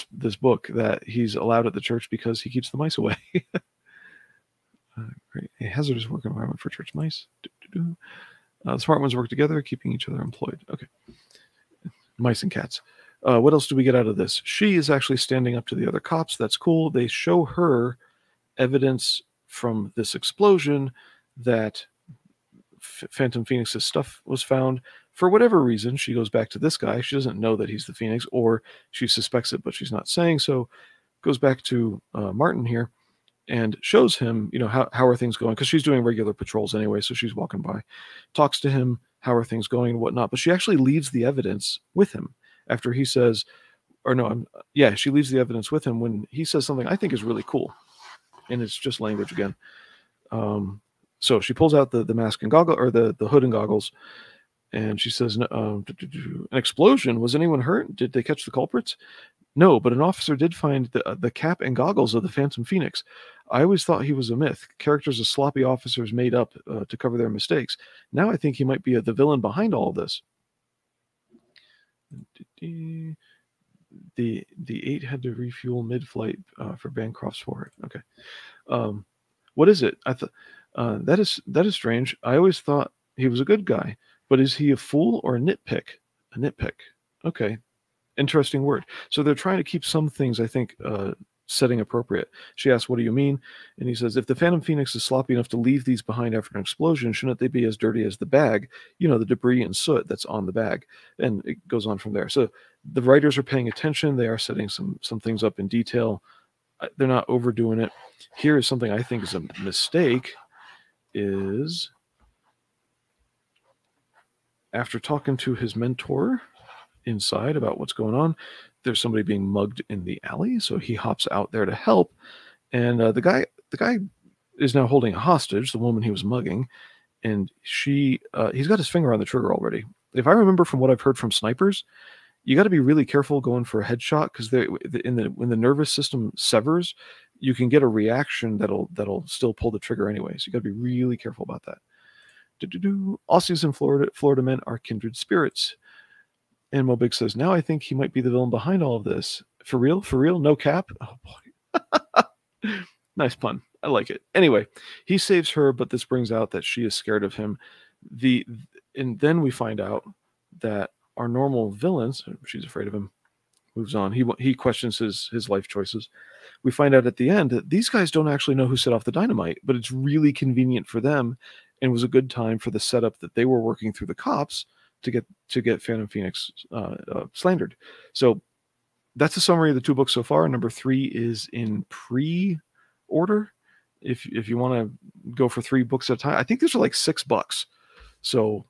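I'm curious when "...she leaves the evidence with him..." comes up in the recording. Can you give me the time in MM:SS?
00:44.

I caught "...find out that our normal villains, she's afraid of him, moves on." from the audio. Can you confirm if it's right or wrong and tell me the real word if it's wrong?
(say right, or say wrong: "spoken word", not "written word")
right.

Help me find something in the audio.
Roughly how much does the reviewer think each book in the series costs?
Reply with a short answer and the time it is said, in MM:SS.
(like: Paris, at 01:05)
6 bucks, at 03:06.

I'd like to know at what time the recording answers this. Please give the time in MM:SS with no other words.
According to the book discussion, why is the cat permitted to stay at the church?
00:02.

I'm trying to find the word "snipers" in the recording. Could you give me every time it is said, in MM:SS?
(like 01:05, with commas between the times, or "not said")
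02:11.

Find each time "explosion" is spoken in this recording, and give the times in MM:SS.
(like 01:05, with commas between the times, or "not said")
00:20, 00:56, 01:36.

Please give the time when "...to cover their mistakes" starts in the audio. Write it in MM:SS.
01:06.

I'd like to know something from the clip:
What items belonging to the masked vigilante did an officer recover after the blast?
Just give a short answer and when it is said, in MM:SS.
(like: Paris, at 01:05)
Cap and goggles, at 01:01.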